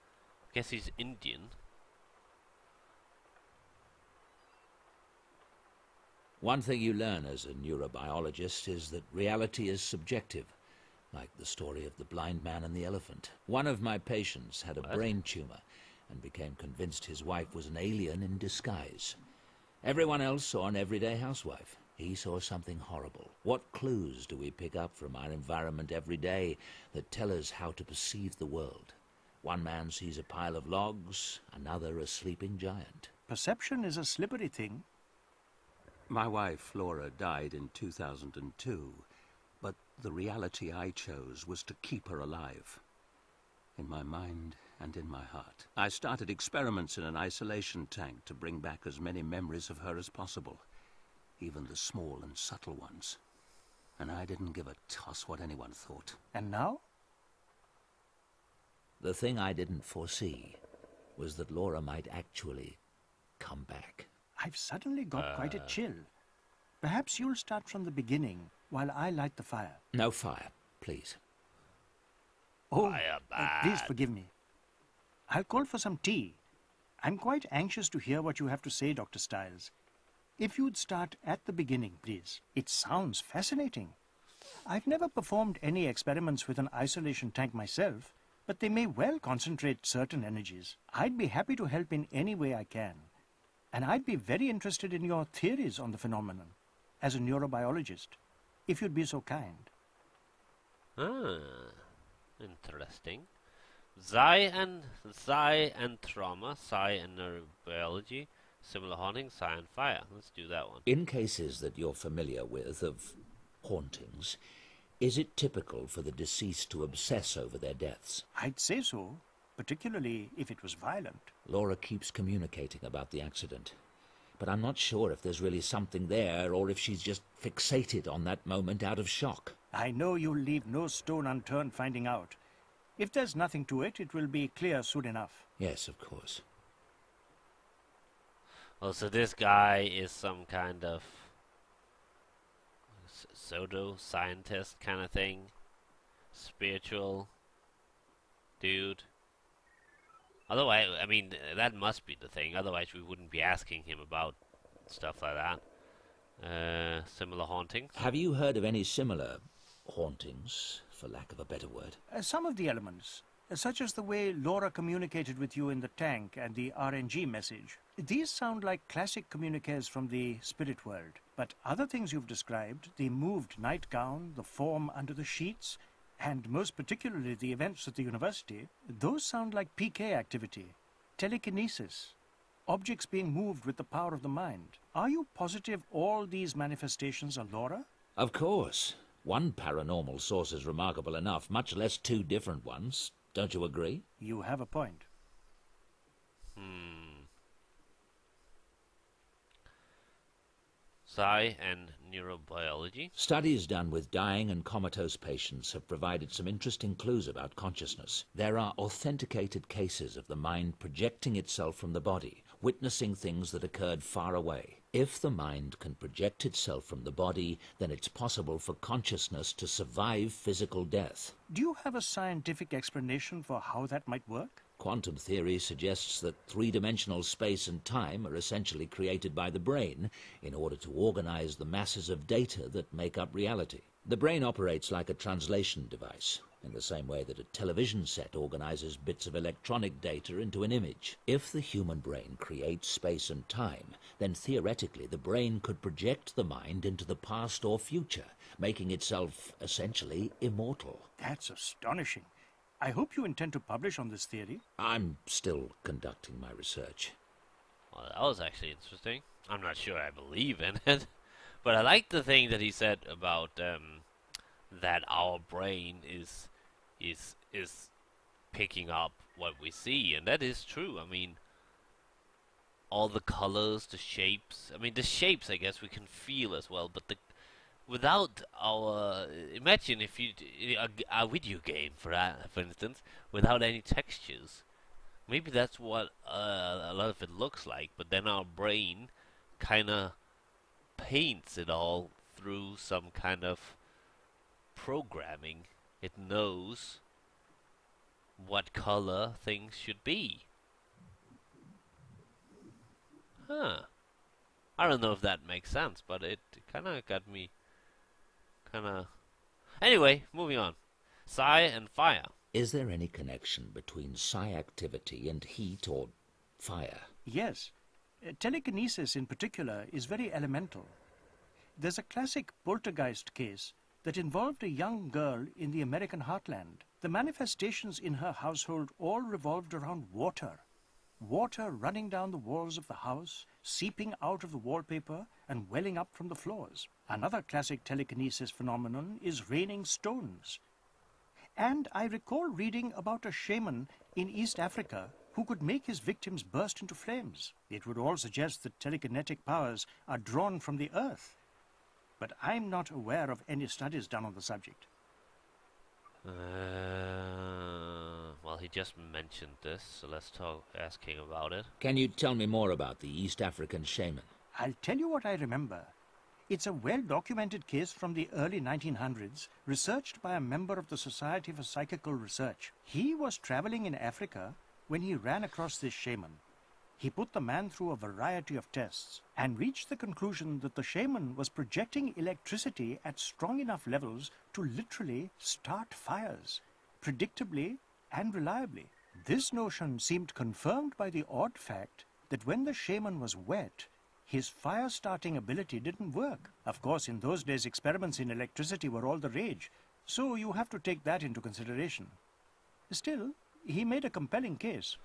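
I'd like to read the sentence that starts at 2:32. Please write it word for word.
Otherwise, we wouldn't be asking him about stuff like that.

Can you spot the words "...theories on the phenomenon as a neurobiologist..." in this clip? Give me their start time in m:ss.
1:35.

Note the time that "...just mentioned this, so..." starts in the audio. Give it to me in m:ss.
5:58.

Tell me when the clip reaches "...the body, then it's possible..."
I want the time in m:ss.
3:37.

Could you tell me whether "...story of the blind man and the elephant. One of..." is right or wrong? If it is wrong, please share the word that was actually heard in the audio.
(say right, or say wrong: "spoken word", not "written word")
right.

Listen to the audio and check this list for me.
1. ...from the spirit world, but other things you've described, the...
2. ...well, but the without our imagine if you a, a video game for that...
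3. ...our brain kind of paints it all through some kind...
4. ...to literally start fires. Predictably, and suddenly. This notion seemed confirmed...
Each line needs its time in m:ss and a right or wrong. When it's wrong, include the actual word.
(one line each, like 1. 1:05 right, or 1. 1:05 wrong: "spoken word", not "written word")
1. 2:49 right
2. 4:36 right
3. 4:48 right
4. 6:24 wrong: "reliably", not "suddenly".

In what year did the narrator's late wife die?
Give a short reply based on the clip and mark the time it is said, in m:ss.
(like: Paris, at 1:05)
2002, at 0:37.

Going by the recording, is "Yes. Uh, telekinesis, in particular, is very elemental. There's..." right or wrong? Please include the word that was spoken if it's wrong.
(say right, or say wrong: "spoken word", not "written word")
right.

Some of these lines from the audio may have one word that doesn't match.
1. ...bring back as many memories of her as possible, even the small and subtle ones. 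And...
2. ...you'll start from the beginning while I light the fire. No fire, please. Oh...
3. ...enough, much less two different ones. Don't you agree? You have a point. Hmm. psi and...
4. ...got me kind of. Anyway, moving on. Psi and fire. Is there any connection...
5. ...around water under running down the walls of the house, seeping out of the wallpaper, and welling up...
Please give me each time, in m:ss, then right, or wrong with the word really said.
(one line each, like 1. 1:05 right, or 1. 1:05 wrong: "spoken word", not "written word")
1. 0:48 right
2. 1:07 right
3. 3:11 right
4. 5:07 right
5. 5:29 wrong: "water", not "under".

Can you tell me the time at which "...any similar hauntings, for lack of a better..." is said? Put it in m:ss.
2:38.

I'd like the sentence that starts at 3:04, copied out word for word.
Are you positive all these manifestations are Laura?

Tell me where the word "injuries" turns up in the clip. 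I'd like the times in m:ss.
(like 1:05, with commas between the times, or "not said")
not said.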